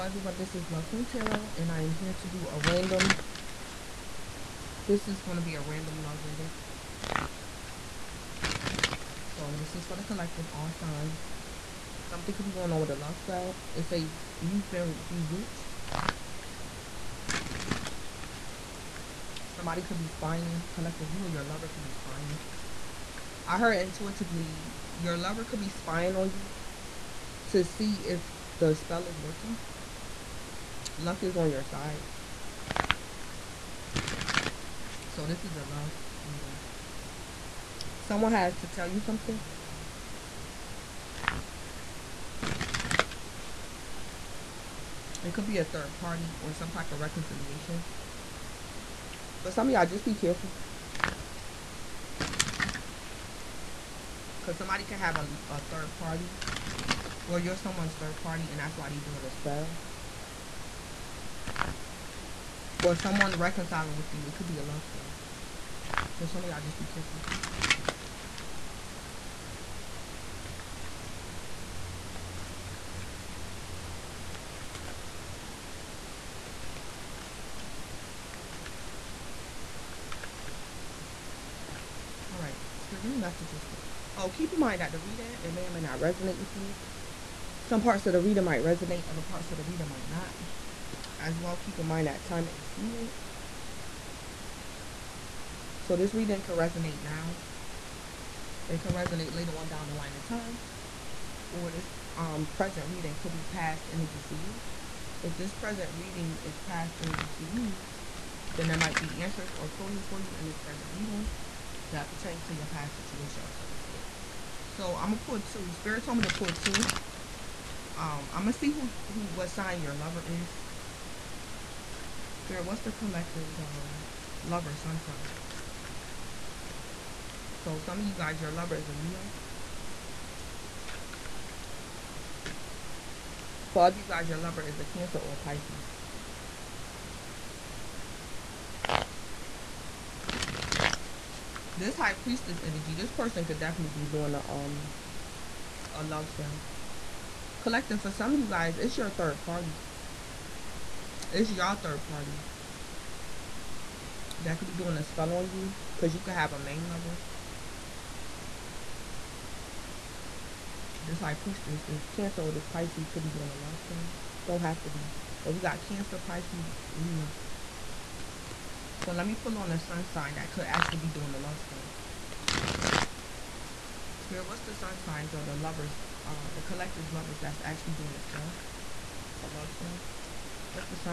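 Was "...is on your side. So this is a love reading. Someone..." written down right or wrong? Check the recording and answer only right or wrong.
right.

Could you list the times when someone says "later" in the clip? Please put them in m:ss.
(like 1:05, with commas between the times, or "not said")
1:39.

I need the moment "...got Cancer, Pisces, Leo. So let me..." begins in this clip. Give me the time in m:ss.
2:45.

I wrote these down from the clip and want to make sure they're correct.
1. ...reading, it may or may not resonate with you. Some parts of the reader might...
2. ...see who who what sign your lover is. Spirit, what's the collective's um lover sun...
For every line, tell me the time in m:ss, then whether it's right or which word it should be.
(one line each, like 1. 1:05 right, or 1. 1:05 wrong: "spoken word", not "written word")
1. 1:24 right
2. 1:58 right.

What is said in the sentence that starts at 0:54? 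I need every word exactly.
Because somebody can have a, a third party.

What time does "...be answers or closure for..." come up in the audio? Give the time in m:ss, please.
1:49.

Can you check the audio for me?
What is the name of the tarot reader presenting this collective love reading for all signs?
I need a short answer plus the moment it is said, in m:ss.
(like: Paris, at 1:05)
Blood Queen Tarot, at 0:00.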